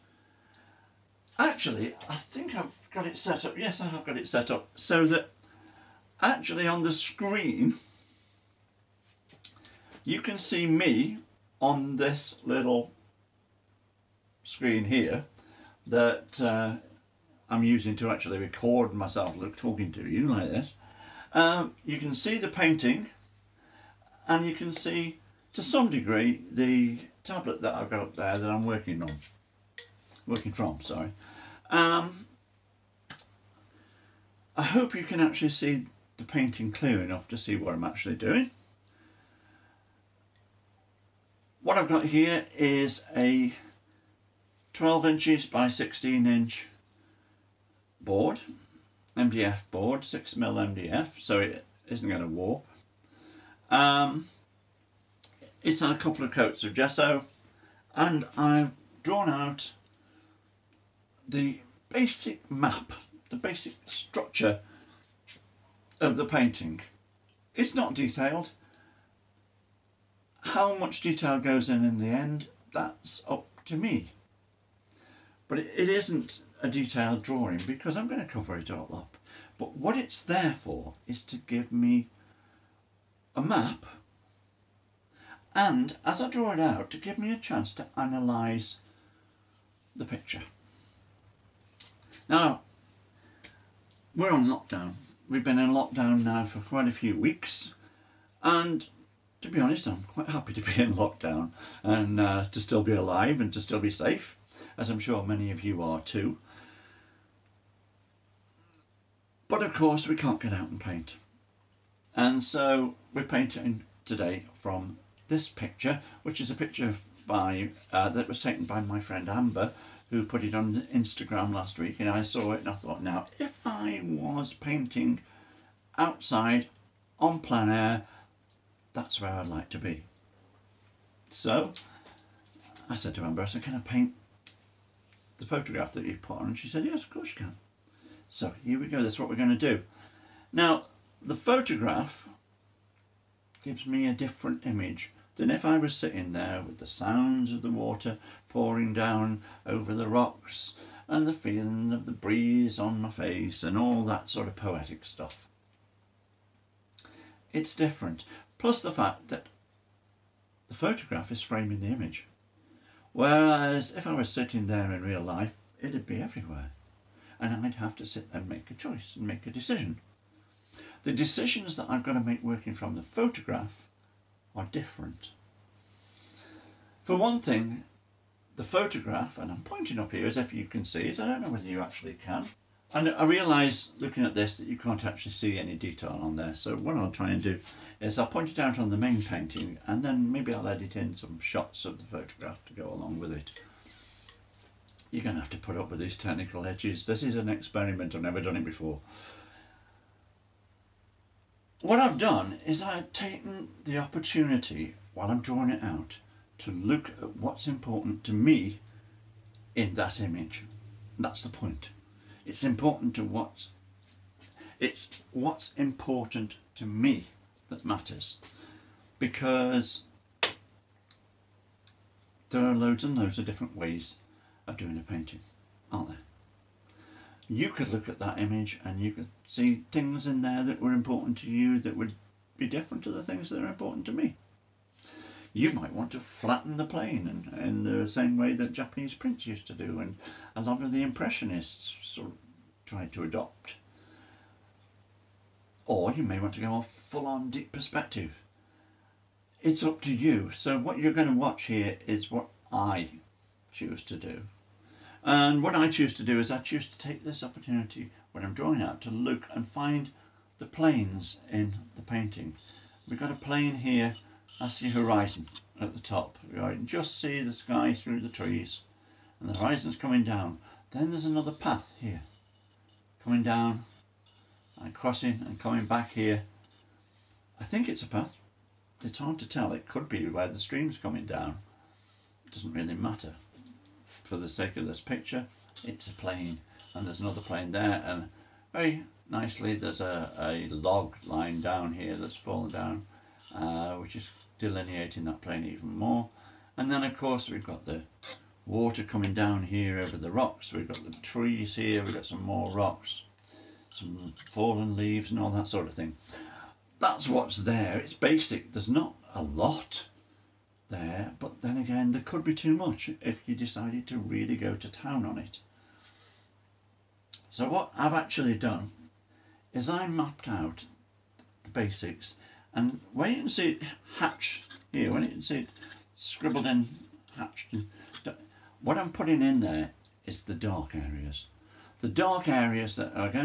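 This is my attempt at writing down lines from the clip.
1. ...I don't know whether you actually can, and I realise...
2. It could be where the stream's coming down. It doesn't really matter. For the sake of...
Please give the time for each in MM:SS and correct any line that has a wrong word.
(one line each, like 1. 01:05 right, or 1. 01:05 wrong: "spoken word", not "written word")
1. 03:01 right
2. 04:39 right.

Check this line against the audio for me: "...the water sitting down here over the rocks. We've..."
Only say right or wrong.
wrong.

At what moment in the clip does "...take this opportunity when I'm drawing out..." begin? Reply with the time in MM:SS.
04:16.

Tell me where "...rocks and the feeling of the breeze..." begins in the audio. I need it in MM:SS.
02:30.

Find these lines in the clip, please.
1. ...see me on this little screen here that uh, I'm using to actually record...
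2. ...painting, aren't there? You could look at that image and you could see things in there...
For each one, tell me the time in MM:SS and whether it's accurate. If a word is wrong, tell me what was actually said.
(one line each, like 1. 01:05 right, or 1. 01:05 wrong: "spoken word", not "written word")
1. 00:10 right
2. 03:45 right.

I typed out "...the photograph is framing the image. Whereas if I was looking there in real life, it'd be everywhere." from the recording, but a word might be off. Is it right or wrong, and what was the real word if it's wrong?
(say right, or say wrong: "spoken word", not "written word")
wrong: "sitting", not "looking".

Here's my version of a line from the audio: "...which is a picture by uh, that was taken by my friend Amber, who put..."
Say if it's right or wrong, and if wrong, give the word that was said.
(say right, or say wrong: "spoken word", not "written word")
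right.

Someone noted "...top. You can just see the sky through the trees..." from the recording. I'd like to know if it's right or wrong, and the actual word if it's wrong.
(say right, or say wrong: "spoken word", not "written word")
right.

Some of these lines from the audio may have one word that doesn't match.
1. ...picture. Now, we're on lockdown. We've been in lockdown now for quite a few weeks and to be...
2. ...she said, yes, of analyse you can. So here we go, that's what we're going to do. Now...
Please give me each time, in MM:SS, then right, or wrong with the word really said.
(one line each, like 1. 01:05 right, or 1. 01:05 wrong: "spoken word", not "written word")
1. 01:30 right
2. 02:16 wrong: "course", not "analyse".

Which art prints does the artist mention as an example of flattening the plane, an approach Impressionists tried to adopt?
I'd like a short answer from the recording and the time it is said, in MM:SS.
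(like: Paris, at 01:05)
Japanese prints, at 03:58.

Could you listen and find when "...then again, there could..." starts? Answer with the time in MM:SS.
05:11.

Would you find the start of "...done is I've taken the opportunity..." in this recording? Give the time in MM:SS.
03:22.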